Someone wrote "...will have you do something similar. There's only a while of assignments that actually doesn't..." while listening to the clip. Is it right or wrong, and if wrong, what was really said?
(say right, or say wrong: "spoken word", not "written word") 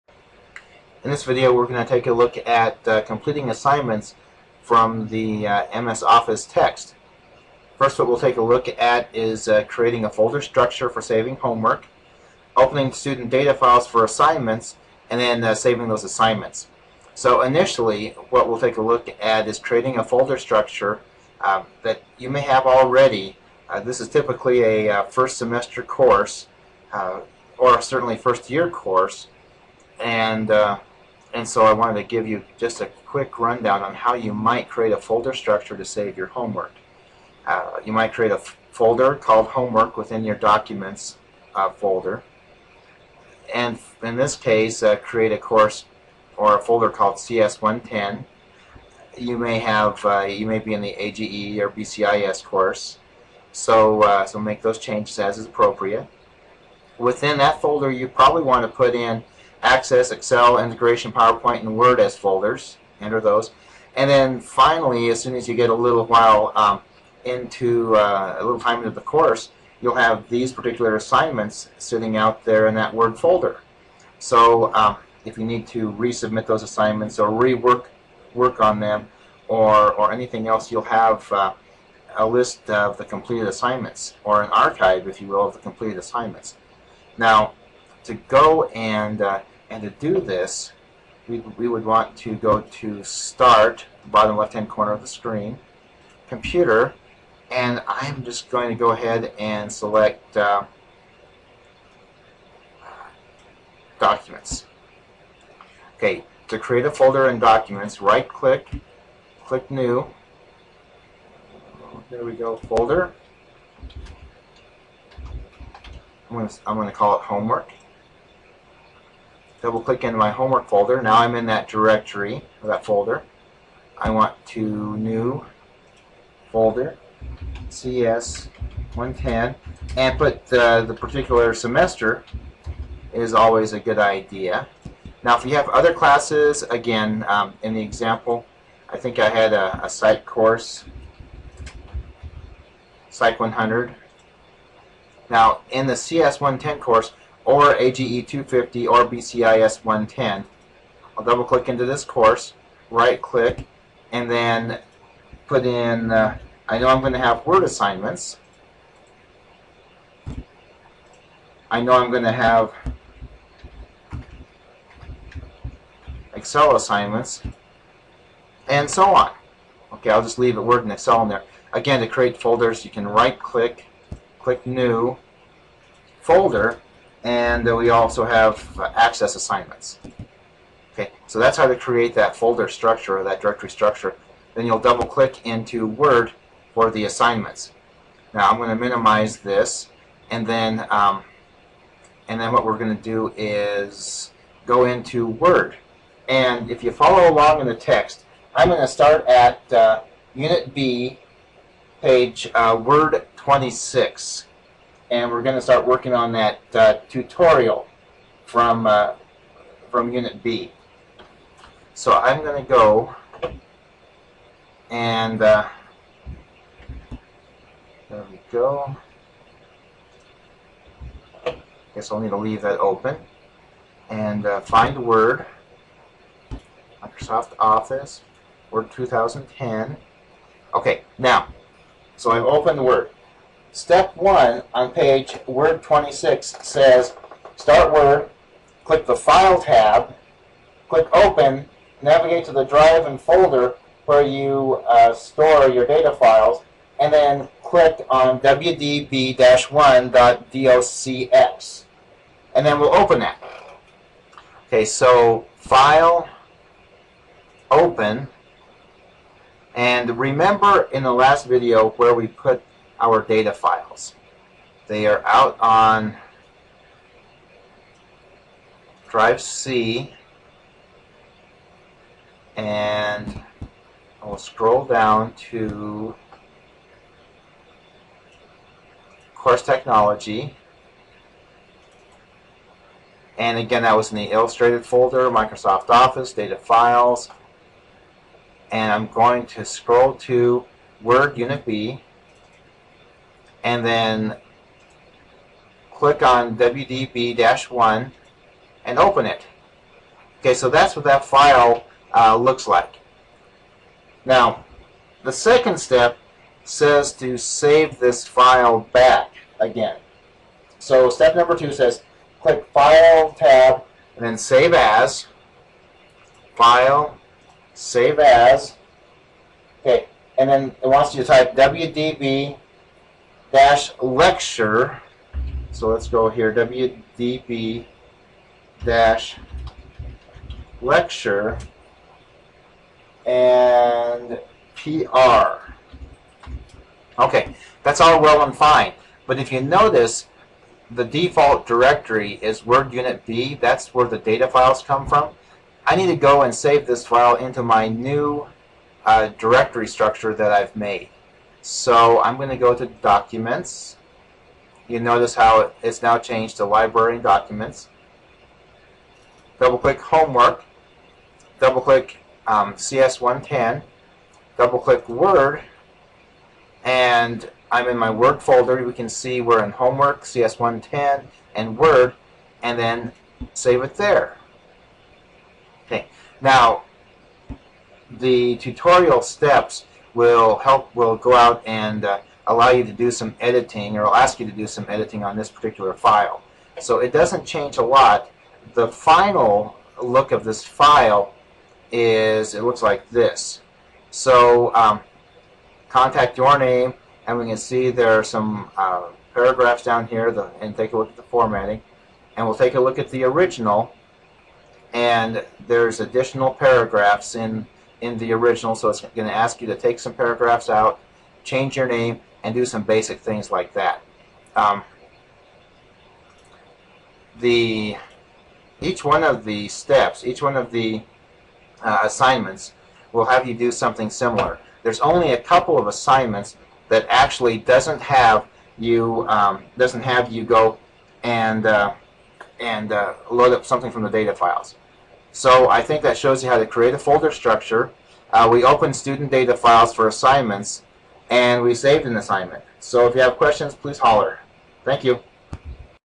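wrong: "couple", not "while".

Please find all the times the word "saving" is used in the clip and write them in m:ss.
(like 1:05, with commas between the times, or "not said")
0:11, 0:15.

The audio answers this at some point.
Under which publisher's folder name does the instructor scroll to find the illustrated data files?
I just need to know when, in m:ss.
4:39.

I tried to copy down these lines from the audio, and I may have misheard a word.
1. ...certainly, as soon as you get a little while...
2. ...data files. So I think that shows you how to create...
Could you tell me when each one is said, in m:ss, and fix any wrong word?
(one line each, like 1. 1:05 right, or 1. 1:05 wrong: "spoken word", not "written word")
1. 1:04 wrong: "finally", not "certainly"
2. 7:14 right.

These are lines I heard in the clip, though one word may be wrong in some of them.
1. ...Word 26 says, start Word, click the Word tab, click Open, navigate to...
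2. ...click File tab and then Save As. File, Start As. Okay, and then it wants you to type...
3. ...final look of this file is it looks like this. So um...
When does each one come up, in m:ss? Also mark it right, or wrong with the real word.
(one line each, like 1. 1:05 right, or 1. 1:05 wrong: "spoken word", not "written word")
1. 3:55 wrong: "File", not "Word"
2. 5:12 wrong: "Save", not "Start"
3. 6:28 right.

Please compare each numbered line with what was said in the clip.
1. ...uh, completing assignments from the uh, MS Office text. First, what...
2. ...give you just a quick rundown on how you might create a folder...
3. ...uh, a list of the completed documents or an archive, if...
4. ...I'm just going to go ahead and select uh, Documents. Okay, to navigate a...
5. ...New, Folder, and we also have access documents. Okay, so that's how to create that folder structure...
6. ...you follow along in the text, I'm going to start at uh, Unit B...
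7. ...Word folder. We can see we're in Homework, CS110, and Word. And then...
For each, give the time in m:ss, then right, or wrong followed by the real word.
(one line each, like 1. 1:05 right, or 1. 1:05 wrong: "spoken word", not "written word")
1. 0:02 right
2. 0:32 right
3. 1:21 wrong: "assignments", not "documents"
4. 1:37 wrong: "create", not "navigate"
5. 2:54 wrong: "assignments", not "documents"
6. 3:16 right
7. 6:08 right.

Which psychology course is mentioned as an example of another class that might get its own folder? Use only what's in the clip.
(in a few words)
Psych 100.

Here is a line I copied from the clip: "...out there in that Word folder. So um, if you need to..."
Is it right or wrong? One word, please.
right.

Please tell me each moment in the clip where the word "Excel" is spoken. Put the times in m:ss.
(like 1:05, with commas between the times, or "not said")
1:00, 2:46, 2:50.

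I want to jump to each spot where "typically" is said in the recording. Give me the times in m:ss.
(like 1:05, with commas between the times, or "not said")
0:24.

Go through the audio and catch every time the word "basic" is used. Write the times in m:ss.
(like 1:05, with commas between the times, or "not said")
6:52.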